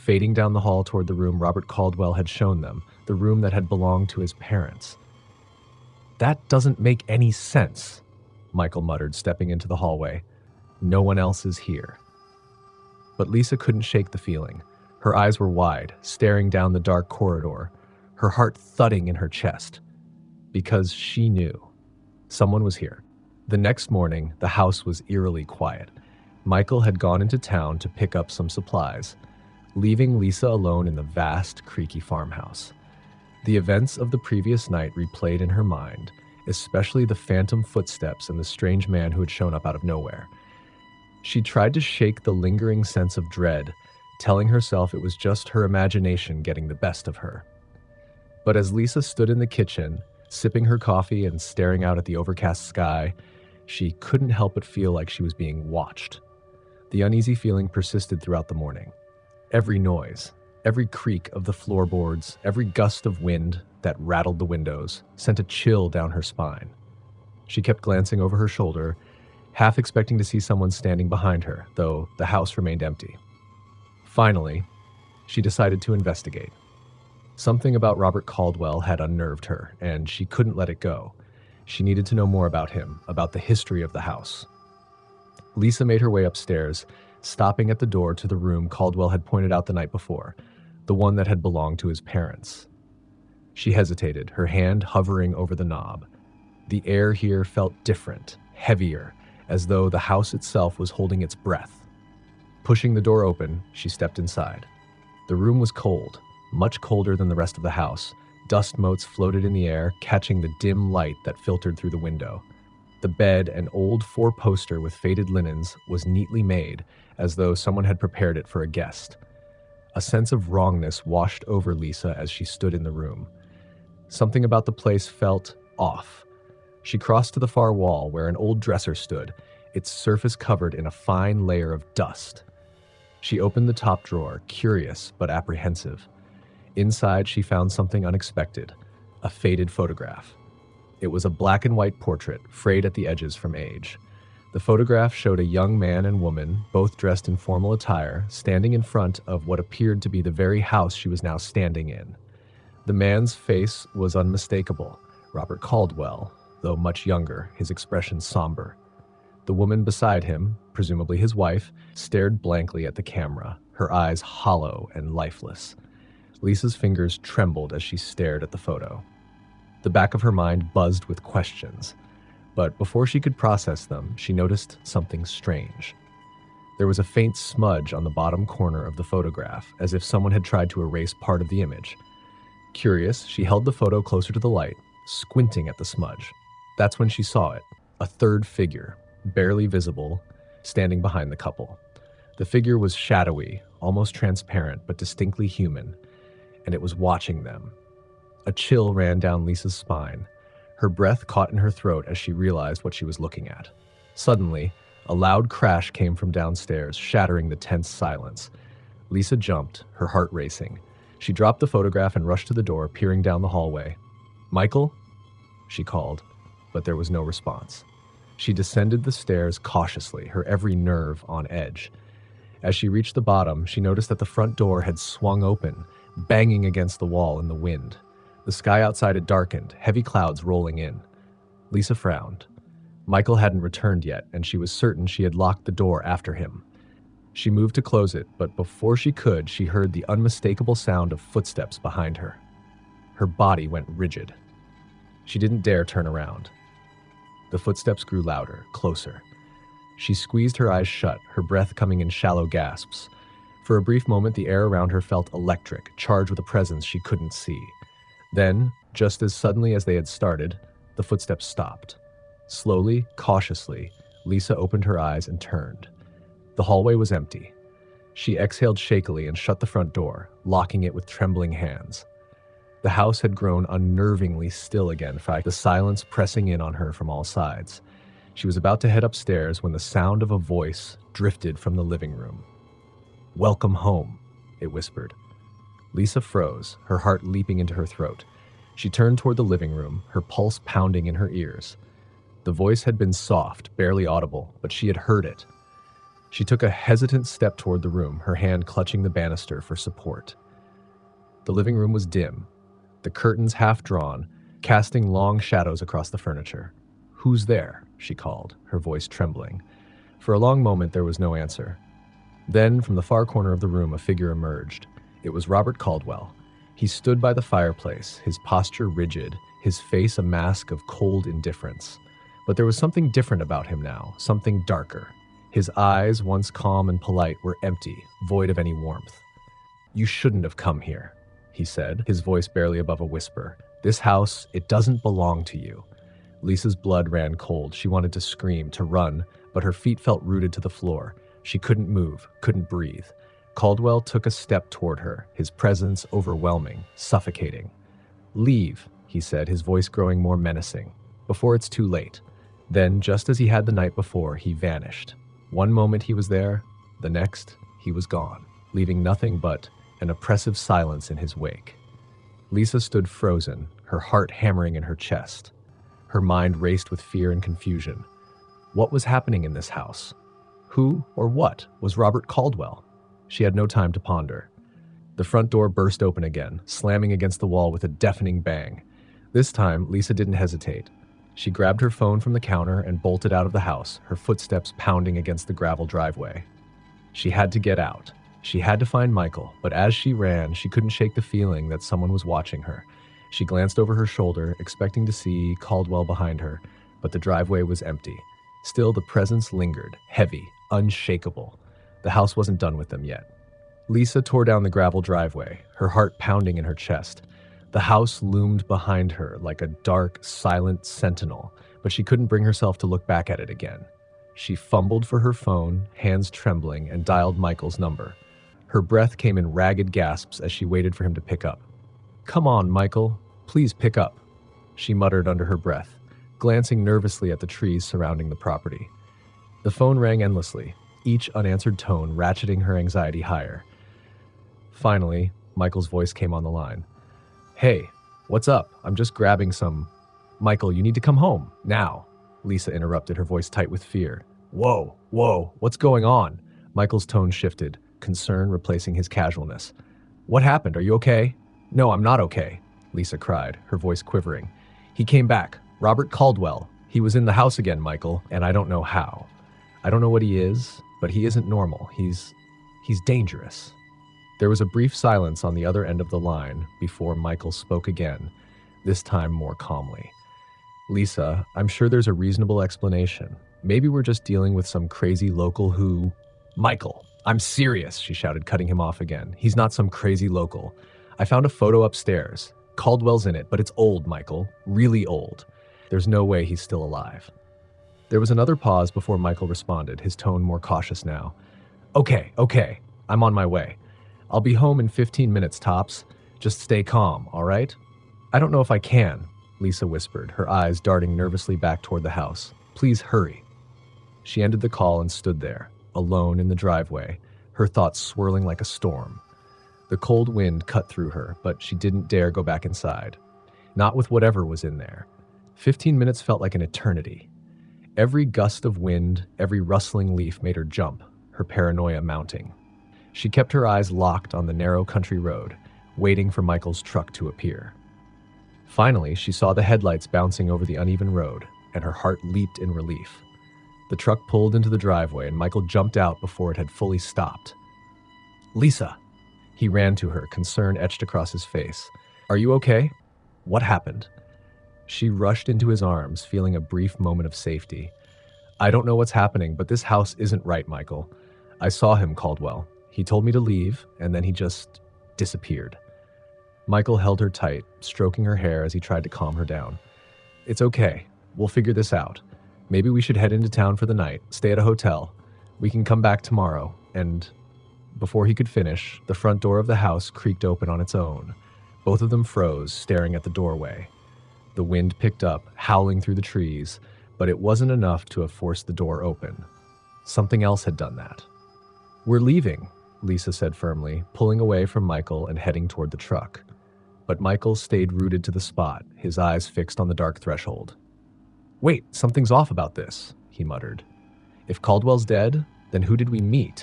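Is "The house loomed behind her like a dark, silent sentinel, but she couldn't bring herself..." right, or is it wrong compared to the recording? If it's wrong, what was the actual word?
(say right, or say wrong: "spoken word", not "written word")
right.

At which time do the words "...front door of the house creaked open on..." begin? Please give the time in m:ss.
9:29.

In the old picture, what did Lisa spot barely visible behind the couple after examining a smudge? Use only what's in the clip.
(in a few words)
A third figure.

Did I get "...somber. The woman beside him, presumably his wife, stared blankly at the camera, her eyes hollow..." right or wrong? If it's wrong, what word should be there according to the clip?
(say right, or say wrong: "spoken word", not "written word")
right.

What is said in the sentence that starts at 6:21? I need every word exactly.
She grabbed her phone from the counter and bolted out of the house, her footsteps pounding against the gravel driveway.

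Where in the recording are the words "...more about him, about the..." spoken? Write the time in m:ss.
1:22.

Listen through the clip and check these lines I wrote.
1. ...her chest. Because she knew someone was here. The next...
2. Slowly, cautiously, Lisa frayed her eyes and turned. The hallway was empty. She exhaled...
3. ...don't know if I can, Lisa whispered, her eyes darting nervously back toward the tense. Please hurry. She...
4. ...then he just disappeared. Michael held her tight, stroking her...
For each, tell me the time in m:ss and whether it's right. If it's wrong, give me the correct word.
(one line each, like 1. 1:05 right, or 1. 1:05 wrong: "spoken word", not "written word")
1. 0:19 right
2. 4:22 wrong: "opened", not "frayed"
3. 8:18 wrong: "house", not "tense"
4. 9:14 right.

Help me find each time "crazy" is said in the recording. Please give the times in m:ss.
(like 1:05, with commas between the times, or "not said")
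7:54, 7:59.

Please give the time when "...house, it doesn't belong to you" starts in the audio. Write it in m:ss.
5:33.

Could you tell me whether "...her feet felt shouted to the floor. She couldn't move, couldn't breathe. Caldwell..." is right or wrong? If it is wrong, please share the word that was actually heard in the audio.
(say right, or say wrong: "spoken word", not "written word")
wrong: "rooted", not "shouted".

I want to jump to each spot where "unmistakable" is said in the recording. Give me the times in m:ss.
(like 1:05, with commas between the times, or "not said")
2:34, 4:00.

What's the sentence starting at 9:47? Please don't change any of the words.
But Michael stayed rooted to the spot, his eyes fixed on the dark threshold.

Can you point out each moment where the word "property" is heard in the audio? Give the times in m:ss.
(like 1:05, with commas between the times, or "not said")
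7:08.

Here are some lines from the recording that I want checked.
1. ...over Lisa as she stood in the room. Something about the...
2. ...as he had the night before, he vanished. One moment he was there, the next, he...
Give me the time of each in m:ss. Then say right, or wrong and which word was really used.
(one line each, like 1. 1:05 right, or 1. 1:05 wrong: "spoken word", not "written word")
1. 2:01 right
2. 5:53 right.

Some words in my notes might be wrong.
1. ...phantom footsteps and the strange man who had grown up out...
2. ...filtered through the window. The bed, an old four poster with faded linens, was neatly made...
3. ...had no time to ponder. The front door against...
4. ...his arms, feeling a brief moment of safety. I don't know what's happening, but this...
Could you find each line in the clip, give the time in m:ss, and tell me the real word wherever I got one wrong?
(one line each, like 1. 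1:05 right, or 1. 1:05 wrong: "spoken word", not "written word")
1. 0:37 wrong: "shown", not "grown"
2. 1:51 right
3. 6:13 wrong: "burst", not "against"
4. 9:05 right.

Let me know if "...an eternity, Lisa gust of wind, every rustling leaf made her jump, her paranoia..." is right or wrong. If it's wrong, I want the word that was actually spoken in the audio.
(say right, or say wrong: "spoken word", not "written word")
wrong: "Every", not "Lisa".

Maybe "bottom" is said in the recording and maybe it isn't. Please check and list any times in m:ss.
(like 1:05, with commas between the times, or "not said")
2:58, 3:43.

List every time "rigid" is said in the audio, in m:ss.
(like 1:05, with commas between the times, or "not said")
4:03, 5:18.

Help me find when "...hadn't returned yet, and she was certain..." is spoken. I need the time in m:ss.
3:53.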